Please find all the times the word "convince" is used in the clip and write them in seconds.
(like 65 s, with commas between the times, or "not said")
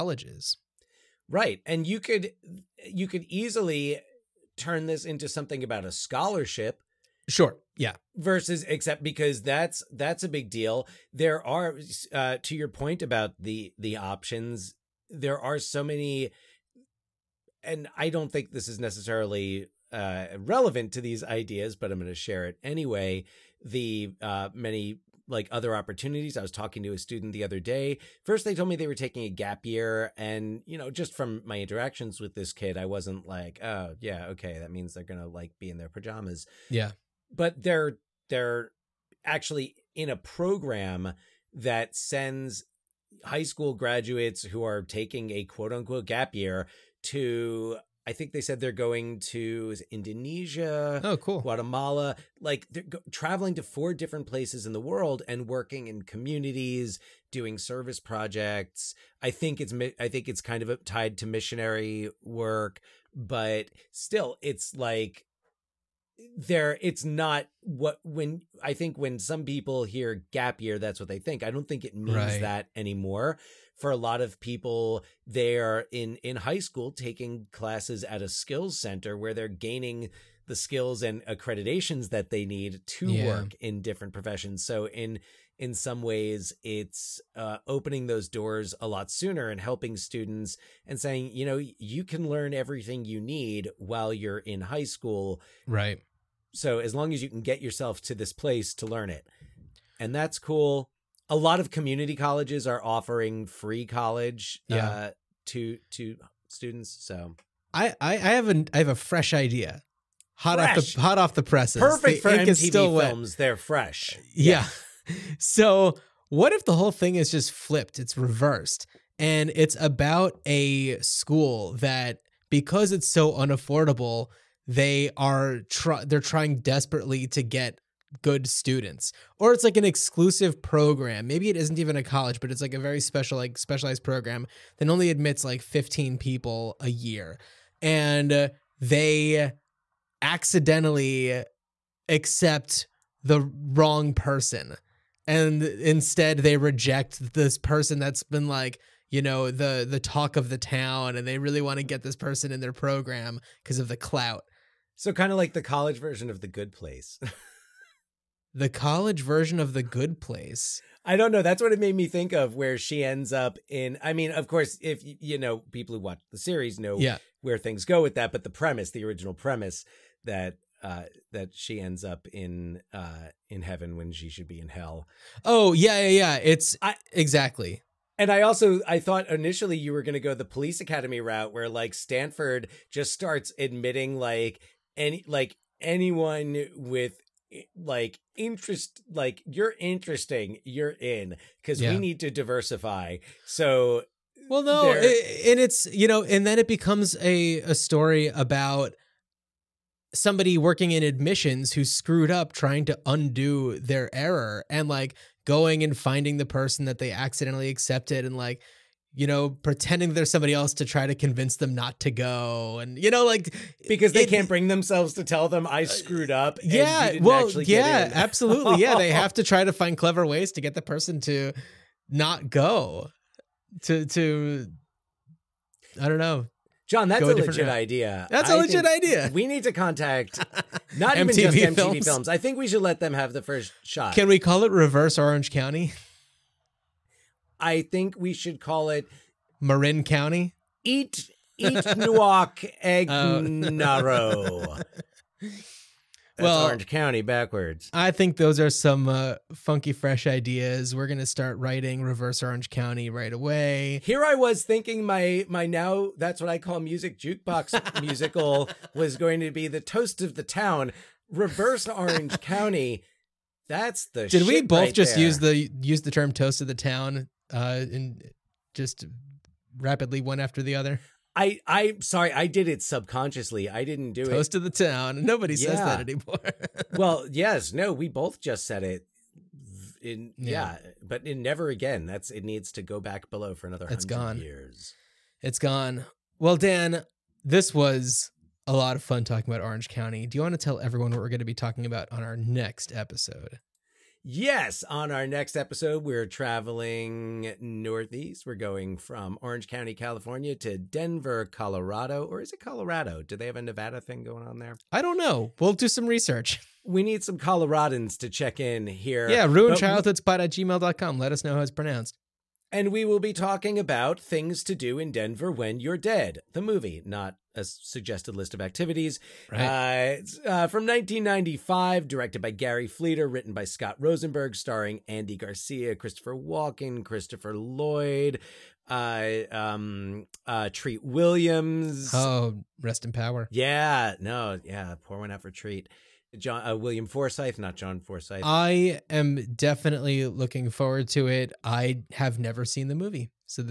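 211 s.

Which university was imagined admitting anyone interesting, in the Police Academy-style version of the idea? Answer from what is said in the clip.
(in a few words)
Stanford.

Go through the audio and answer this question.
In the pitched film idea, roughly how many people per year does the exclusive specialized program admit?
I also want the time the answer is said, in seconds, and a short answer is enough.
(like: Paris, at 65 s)
15, at 135 s.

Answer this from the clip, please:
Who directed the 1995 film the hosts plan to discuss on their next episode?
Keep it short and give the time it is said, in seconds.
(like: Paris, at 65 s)
Gary Fleder, at 322 s.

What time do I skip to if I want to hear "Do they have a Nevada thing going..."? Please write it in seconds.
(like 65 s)
303 s.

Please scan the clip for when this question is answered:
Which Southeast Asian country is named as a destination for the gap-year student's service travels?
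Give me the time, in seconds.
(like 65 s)
49 s.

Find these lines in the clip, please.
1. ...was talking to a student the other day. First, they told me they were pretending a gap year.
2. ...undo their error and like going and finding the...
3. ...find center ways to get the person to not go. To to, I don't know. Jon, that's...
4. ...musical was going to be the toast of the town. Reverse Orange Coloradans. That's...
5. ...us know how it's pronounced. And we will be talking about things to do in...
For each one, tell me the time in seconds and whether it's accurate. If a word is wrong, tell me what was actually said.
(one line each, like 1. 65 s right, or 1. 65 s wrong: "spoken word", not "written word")
1. 26 s wrong: "taking", not "pretending"
2. 203 s right
3. 219 s wrong: "clever", not "center"
4. 258 s wrong: "County", not "Coloradans"
5. 311 s right.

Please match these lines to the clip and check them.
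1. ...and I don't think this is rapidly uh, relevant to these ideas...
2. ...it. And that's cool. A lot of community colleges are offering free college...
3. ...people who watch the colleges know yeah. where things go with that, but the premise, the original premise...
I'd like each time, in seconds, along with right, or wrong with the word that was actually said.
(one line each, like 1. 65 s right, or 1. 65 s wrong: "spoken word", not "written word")
1. 17 s wrong: "necessarily", not "rapidly"
2. 99 s right
3. 165 s wrong: "series", not "colleges".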